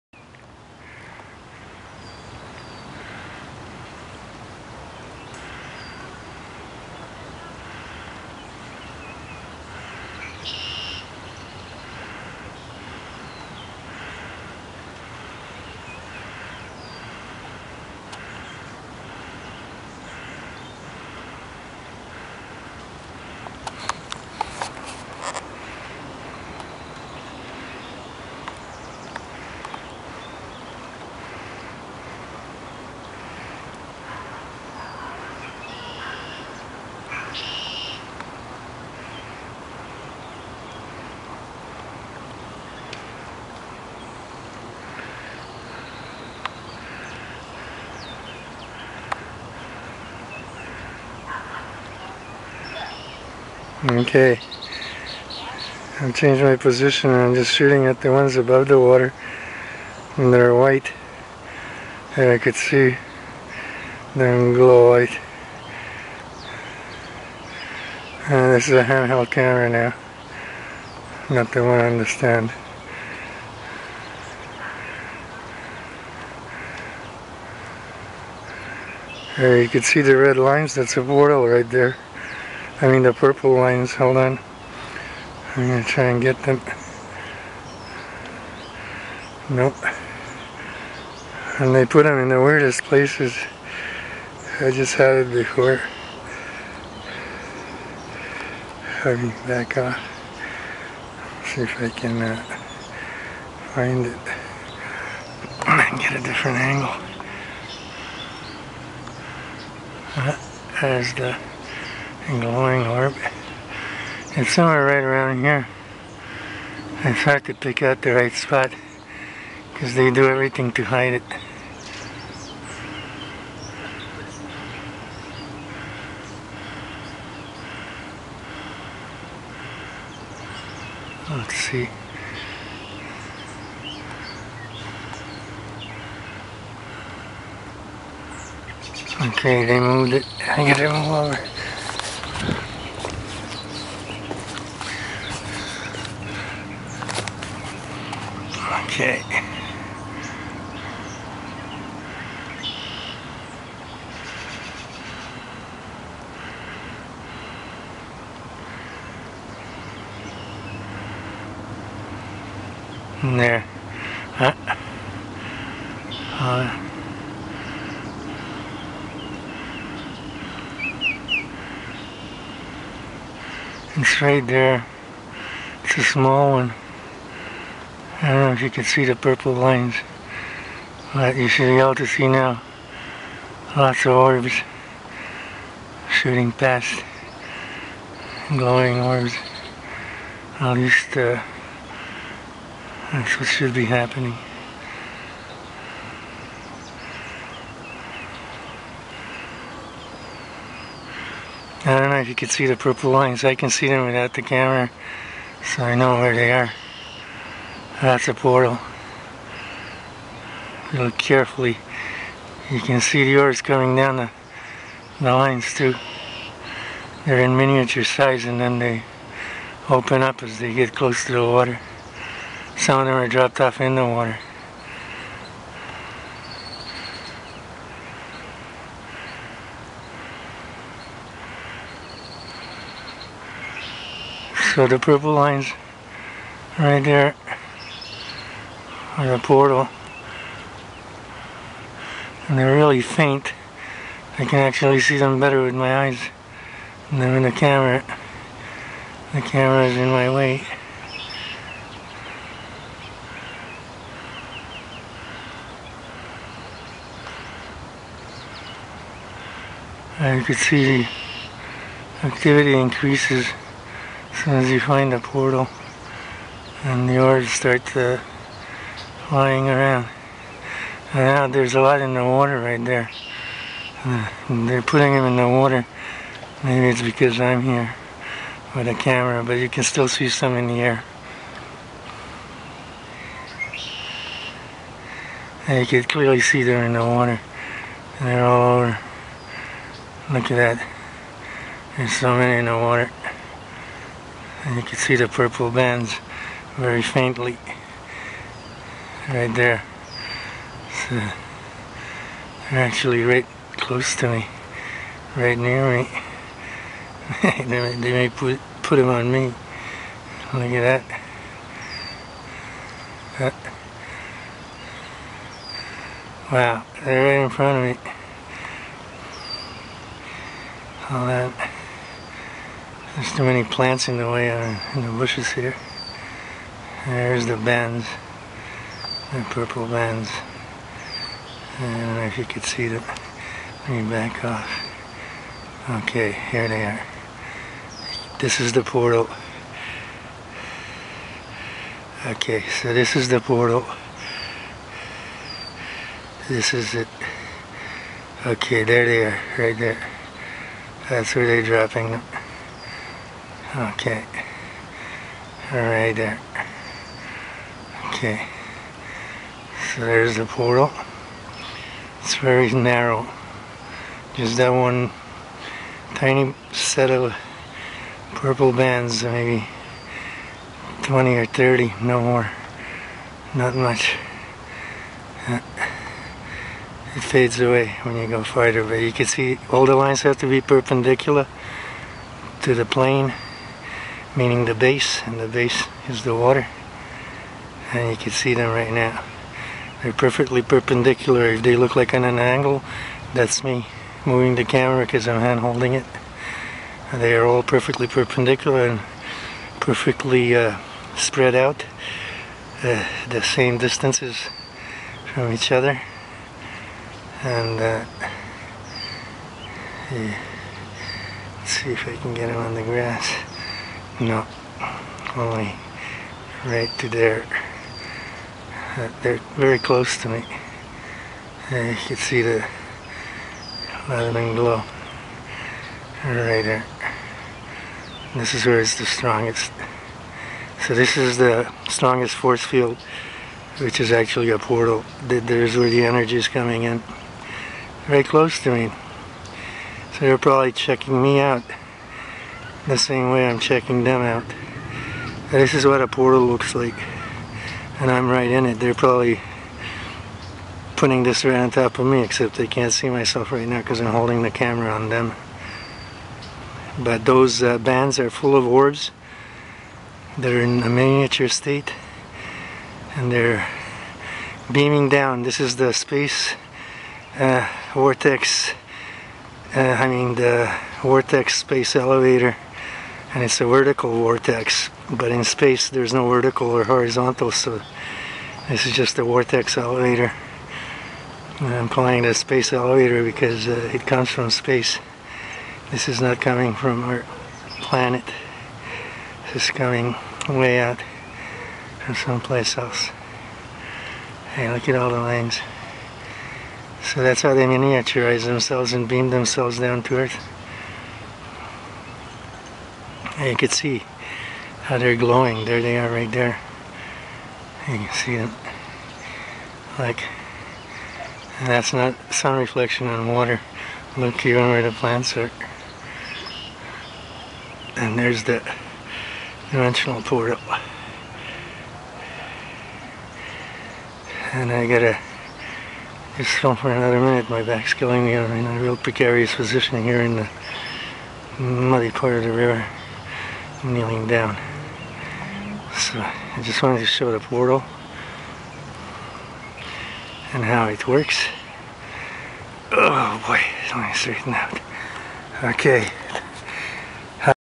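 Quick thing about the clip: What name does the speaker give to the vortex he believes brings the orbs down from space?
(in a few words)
Vortex space elevator.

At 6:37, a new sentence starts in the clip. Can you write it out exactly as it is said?
they are all perfectly perpendicular and perfectly uh, spread out uh, the same distances from each other and uh, yeah.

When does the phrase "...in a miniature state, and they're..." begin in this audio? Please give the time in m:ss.
7:40.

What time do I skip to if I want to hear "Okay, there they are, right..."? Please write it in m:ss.
5:48.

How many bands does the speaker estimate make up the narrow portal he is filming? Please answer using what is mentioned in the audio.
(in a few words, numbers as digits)
20 or 30.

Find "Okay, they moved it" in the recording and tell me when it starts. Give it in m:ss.
2:19.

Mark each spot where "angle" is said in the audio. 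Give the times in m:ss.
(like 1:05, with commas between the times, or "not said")
1:46, 6:32.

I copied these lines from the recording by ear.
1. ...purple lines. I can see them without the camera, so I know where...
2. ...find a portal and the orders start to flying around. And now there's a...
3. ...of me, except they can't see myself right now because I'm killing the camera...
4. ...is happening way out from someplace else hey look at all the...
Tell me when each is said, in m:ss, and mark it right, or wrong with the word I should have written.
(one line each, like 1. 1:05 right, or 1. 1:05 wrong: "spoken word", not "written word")
1. 3:22 right
2. 4:24 right
3. 7:31 wrong: "holding", not "killing"
4. 8:09 wrong: "coming", not "happening".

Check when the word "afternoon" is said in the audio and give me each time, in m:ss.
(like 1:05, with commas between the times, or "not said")
not said.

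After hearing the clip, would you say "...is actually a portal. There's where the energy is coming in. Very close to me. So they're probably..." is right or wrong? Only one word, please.
right.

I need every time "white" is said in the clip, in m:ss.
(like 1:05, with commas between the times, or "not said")
1:00, 1:04.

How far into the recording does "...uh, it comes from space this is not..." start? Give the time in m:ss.
8:03.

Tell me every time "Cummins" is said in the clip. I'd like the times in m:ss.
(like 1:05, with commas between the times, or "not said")
not said.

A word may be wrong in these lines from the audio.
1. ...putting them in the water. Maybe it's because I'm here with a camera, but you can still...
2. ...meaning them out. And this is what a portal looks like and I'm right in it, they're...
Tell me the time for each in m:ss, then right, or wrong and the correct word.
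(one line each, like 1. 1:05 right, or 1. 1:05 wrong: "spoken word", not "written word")
1. 4:34 right
2. 7:23 wrong: "checking", not "meaning".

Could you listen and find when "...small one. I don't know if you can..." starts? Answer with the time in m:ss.
2:56.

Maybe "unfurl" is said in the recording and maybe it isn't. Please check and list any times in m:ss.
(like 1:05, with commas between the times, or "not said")
not said.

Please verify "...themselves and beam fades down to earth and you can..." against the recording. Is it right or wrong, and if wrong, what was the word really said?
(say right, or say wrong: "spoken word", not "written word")
wrong: "themselves", not "fades".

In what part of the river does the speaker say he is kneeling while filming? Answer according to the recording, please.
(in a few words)
The muddy part.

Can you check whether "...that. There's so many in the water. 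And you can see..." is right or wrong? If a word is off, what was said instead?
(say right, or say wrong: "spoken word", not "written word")
right.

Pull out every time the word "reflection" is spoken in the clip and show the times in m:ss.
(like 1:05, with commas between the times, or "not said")
8:32.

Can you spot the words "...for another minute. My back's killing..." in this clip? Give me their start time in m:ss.
8:46.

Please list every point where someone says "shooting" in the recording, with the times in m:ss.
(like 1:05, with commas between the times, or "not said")
0:57, 3:06.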